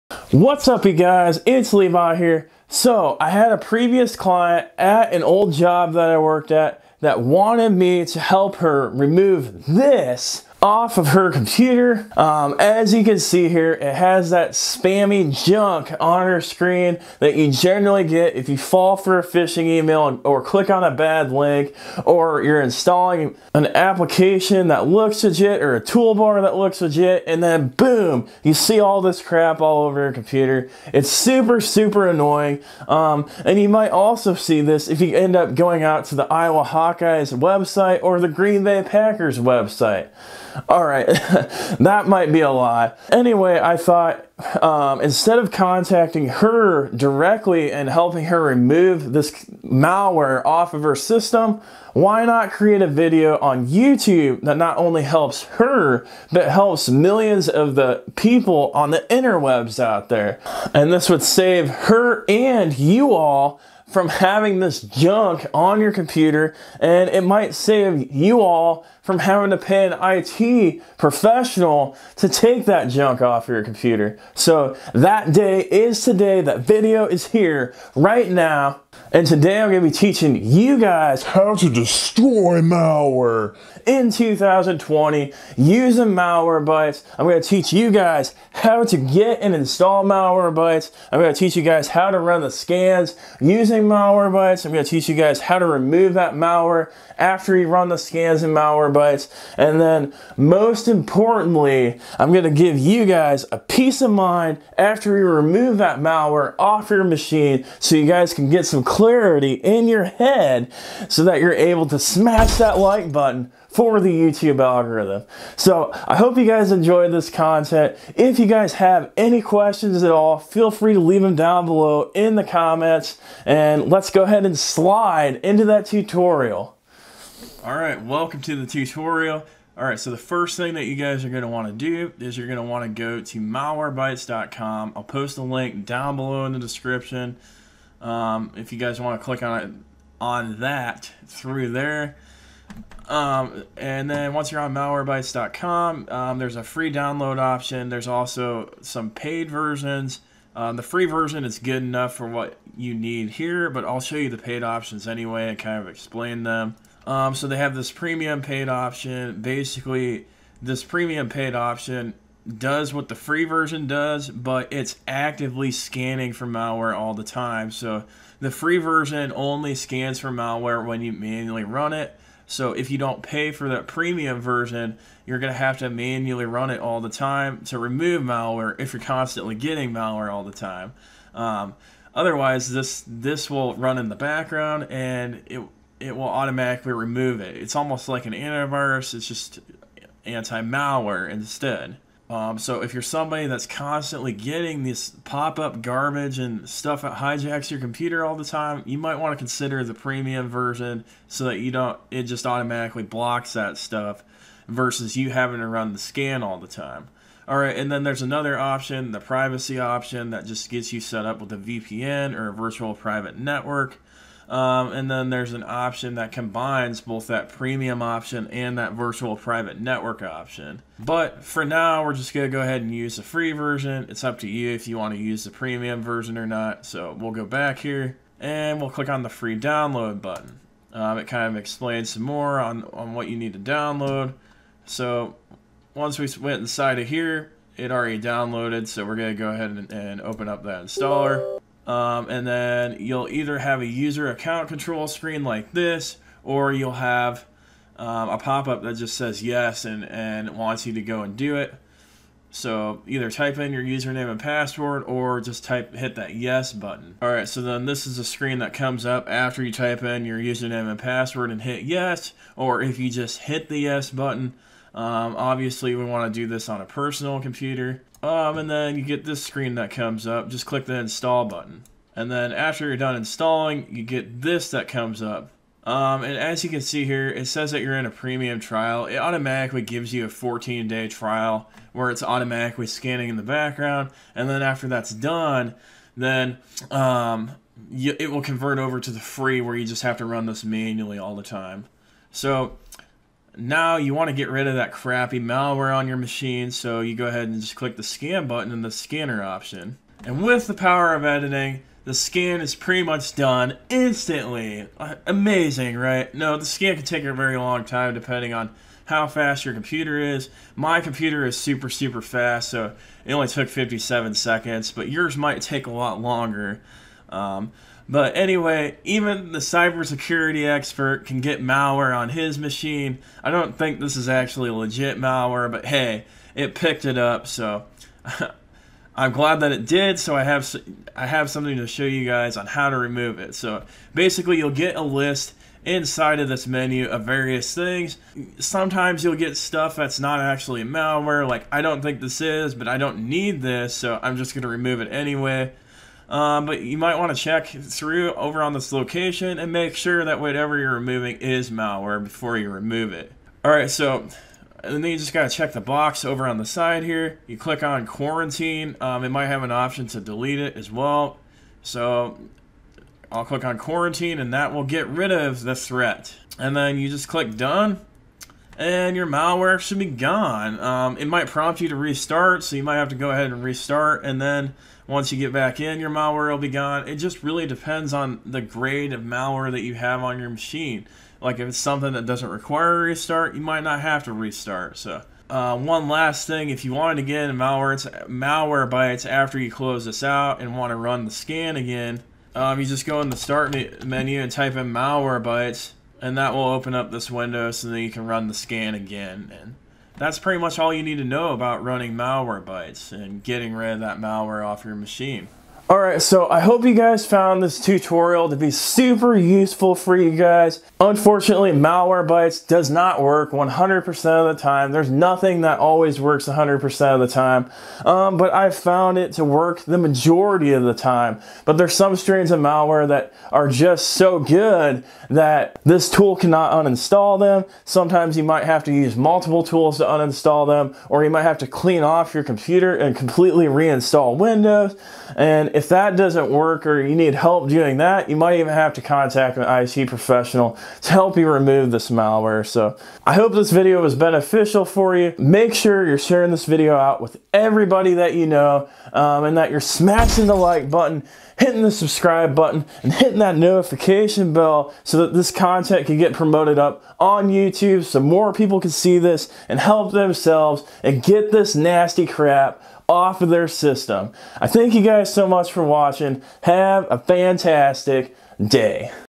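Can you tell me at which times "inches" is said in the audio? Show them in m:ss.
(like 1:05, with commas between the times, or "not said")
not said.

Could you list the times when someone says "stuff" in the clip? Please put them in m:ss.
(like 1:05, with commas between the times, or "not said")
3:16, 3:23, 5:39.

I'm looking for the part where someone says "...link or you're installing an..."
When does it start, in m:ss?
0:21.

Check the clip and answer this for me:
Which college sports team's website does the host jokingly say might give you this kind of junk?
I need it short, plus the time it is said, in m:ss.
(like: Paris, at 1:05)
Iowa Hawkeyes, at 0:36.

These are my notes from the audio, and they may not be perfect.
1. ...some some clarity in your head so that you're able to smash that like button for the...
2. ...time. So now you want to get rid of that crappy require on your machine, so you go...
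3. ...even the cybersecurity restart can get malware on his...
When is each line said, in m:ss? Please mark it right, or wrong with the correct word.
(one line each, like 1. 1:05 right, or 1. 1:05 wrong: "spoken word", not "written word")
1. 1:48 right
2. 4:51 wrong: "malware", not "require"
3. 5:19 wrong: "expert", not "restart".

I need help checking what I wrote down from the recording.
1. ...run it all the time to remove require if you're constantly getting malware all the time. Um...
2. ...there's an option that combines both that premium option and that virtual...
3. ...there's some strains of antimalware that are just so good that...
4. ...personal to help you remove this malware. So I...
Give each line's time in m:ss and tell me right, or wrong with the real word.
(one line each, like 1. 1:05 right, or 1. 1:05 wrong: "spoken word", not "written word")
1. 2:56 wrong: "malware", not "require"
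2. 3:35 right
3. 7:01 wrong: "malware", not "antimalware"
4. 7:20 wrong: "professional", not "personal".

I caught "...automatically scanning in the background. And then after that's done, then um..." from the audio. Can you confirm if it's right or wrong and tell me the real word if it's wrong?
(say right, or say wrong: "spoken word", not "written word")
right.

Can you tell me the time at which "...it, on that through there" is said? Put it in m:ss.
2:19.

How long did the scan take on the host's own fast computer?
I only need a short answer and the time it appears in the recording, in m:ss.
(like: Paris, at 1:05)
57 seconds, at 5:13.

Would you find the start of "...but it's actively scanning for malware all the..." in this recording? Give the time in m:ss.
2:44.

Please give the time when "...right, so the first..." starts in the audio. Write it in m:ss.
2:09.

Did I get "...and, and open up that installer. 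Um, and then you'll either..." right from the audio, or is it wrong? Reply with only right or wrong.
right.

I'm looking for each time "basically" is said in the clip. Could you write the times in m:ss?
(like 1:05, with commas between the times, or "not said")
2:39, 5:34.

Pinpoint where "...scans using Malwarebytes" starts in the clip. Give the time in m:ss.
1:32.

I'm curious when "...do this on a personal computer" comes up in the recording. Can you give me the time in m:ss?
4:26.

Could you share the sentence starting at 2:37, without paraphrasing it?
Um, so they have this premium paid option.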